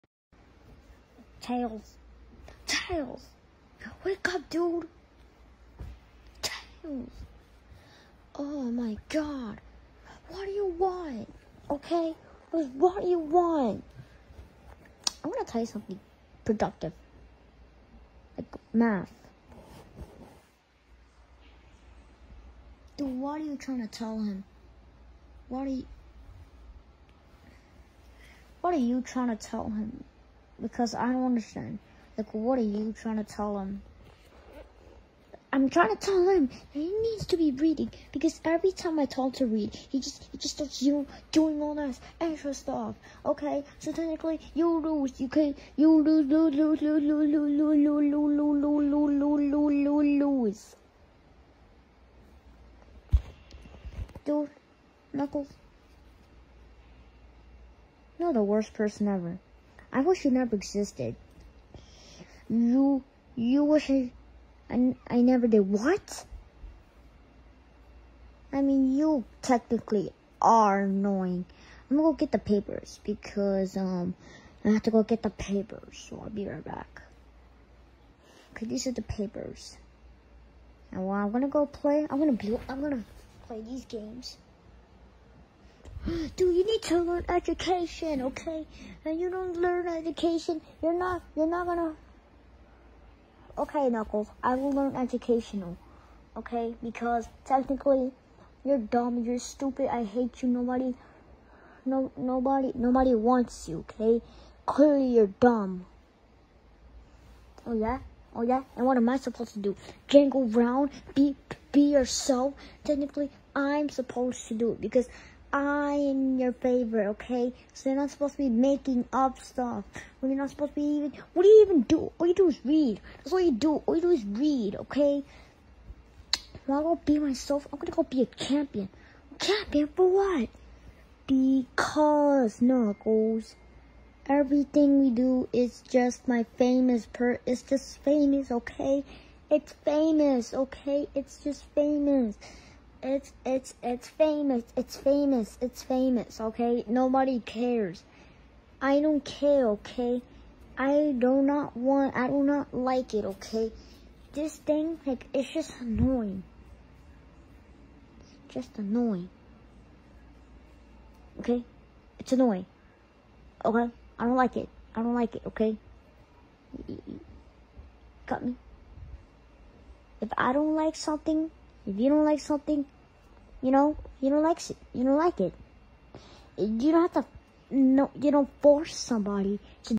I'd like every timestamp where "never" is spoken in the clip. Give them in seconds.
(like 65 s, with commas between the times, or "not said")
60 s, 65 s.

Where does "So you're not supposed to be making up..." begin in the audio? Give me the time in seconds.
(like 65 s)
117 s.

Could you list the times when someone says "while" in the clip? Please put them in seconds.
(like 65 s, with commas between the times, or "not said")
81 s.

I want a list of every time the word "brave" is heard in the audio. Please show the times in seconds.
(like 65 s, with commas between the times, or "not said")
not said.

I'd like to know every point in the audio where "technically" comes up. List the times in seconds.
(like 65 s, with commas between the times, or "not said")
43 s, 69 s, 97 s, 112 s.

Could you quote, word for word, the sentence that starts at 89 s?
And you don't learn education, you're not, you're not gonna.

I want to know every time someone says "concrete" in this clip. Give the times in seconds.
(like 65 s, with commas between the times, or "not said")
not said.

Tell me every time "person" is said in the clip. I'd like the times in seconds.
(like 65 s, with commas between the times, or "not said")
58 s.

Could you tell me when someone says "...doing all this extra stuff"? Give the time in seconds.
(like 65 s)
41 s.